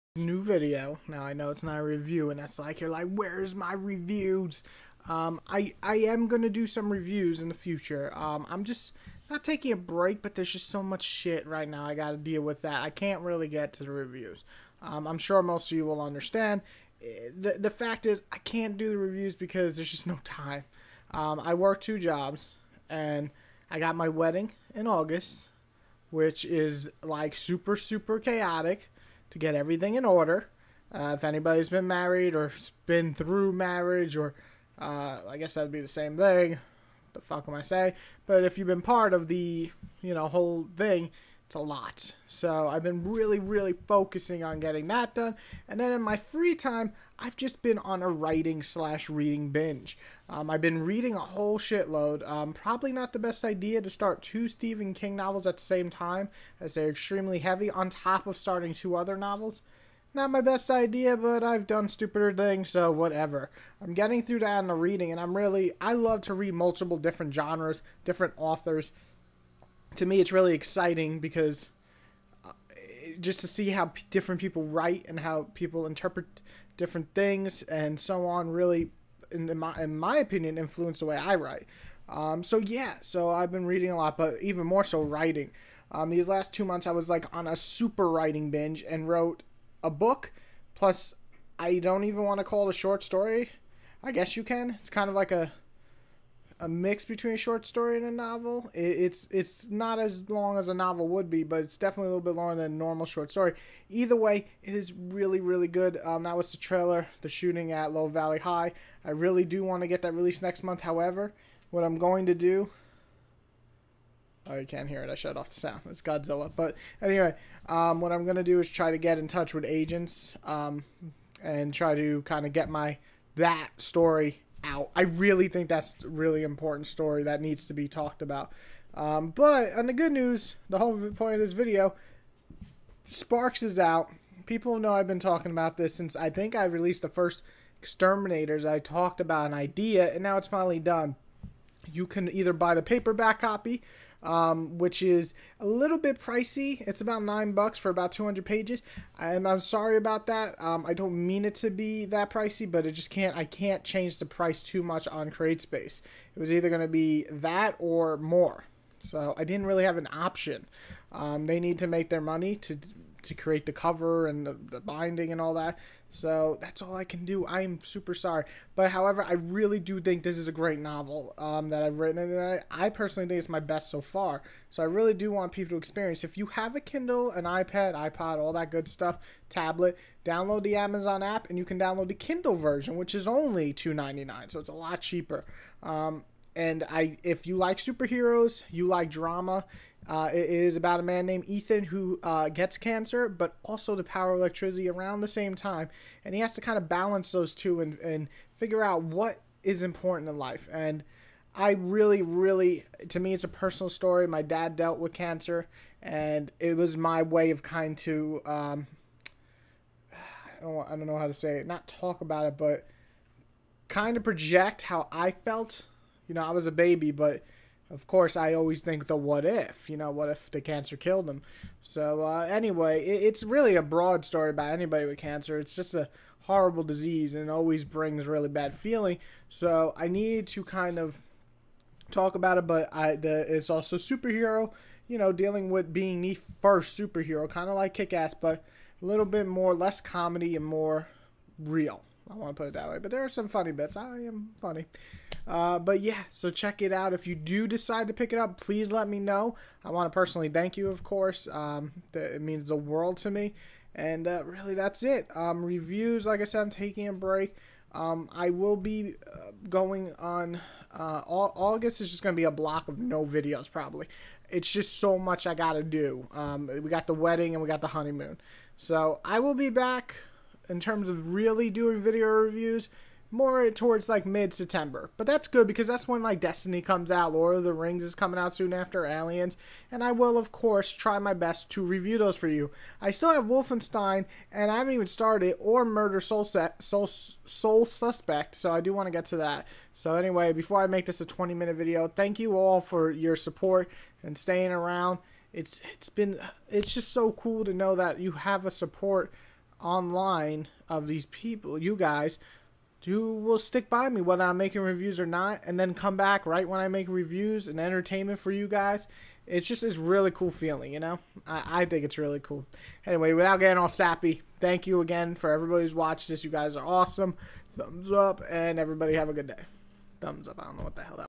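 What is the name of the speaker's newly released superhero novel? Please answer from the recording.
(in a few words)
Sparks.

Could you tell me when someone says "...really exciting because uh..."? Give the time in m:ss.
1:10.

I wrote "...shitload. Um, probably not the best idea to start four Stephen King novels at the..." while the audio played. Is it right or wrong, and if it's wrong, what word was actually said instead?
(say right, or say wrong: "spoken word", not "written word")
wrong: "two", not "four".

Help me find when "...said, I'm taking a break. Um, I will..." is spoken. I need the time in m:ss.
4:16.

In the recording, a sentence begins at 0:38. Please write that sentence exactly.
But if you've been part of the you know whole thing, it's a lot.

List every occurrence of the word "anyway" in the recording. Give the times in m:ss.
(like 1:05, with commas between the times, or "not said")
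1:57, 3:42, 4:50, 5:13.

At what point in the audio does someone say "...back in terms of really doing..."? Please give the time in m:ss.
4:29.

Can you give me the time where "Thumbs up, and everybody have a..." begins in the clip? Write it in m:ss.
5:17.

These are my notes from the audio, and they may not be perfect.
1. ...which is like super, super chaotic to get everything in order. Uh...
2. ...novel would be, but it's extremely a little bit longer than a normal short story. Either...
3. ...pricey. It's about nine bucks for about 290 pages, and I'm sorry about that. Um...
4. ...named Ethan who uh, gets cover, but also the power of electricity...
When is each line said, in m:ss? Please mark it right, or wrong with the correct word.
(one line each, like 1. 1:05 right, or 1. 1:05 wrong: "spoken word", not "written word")
1. 0:26 right
2. 1:40 wrong: "definitely", not "extremely"
3. 2:26 wrong: "200", not "290"
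4. 3:11 wrong: "cancer", not "cover".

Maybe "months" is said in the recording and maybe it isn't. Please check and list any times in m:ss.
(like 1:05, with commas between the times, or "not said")
1:26, 1:50.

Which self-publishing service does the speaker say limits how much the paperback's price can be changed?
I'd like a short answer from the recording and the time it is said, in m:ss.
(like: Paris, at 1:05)
CreateSpace, at 2:35.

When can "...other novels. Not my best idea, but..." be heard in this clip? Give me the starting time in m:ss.
0:58.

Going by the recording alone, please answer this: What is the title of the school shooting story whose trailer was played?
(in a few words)
The Shooting at Low Valley High.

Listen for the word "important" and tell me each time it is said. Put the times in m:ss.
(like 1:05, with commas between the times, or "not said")
2:06, 3:19.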